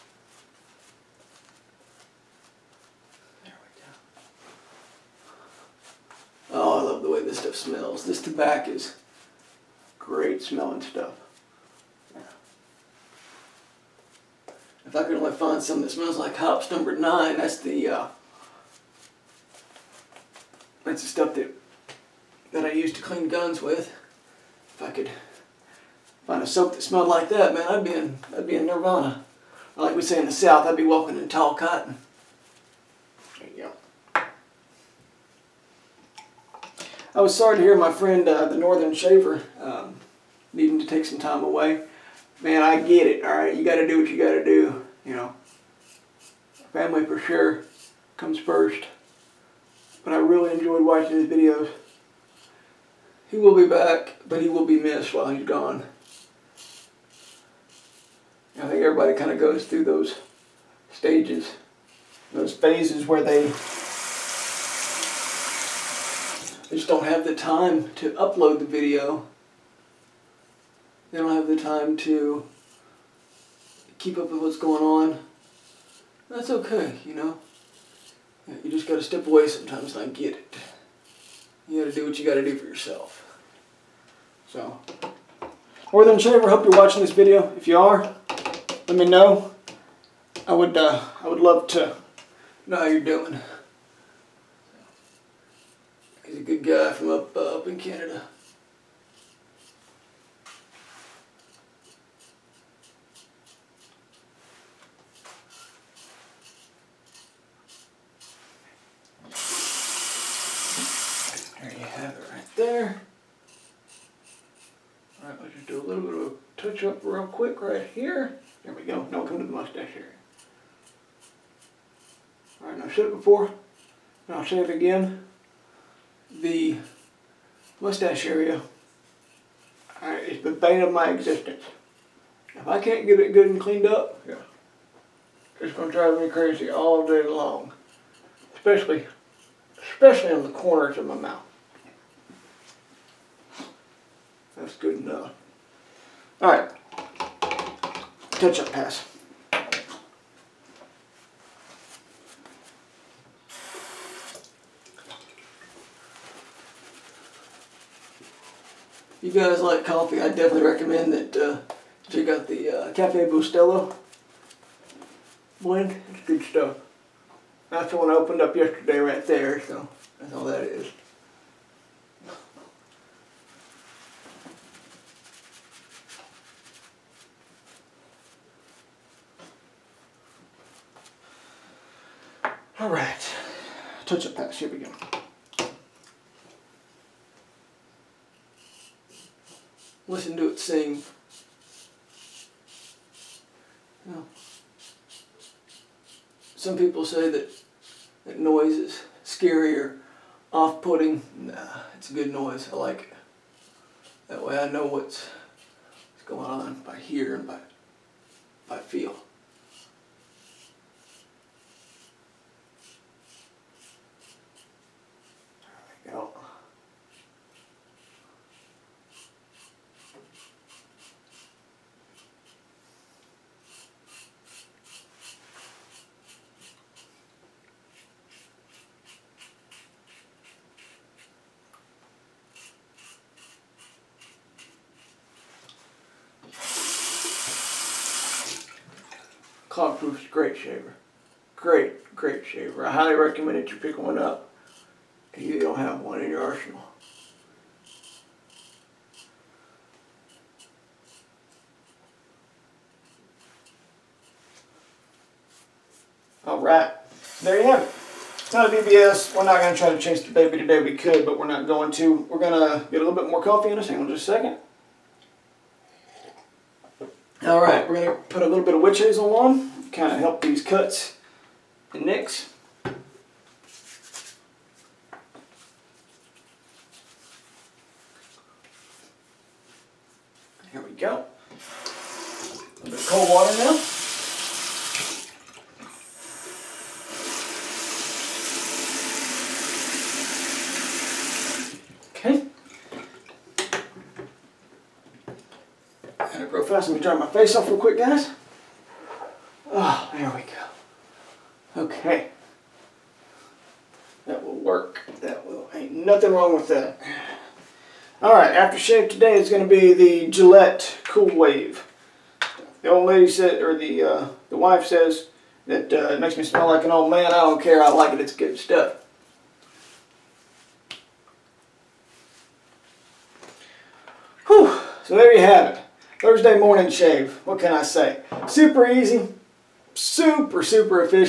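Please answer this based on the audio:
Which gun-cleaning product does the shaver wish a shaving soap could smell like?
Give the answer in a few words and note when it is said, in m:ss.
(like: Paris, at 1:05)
Hoppe's number 9, at 0:16.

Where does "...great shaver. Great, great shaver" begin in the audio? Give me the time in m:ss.
4:00.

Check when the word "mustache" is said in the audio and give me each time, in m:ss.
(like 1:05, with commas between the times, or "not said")
1:59, 2:07.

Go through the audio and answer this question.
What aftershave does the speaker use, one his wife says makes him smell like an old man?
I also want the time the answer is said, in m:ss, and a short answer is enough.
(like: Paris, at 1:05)
Gillette Cool Wave, at 5:10.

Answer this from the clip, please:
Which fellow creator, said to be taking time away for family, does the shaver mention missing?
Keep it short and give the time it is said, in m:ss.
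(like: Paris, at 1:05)
The Northern Shaver, at 0:38.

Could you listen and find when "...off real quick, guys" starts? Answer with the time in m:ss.
4:57.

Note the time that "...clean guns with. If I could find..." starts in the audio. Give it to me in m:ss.
0:23.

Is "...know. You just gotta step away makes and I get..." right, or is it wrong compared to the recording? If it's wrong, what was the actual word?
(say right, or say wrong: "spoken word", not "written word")
wrong: "sometimes", not "makes".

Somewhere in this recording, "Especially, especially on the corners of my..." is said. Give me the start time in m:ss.
2:18.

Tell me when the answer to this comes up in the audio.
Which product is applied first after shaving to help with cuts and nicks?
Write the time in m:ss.
4:28.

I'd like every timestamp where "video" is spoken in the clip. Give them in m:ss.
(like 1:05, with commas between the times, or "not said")
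0:51, 1:08, 1:27.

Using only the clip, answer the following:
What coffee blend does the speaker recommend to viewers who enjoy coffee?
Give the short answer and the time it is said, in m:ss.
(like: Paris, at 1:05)
Cafe Bustelo, at 2:42.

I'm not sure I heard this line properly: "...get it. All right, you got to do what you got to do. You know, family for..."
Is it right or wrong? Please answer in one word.
right.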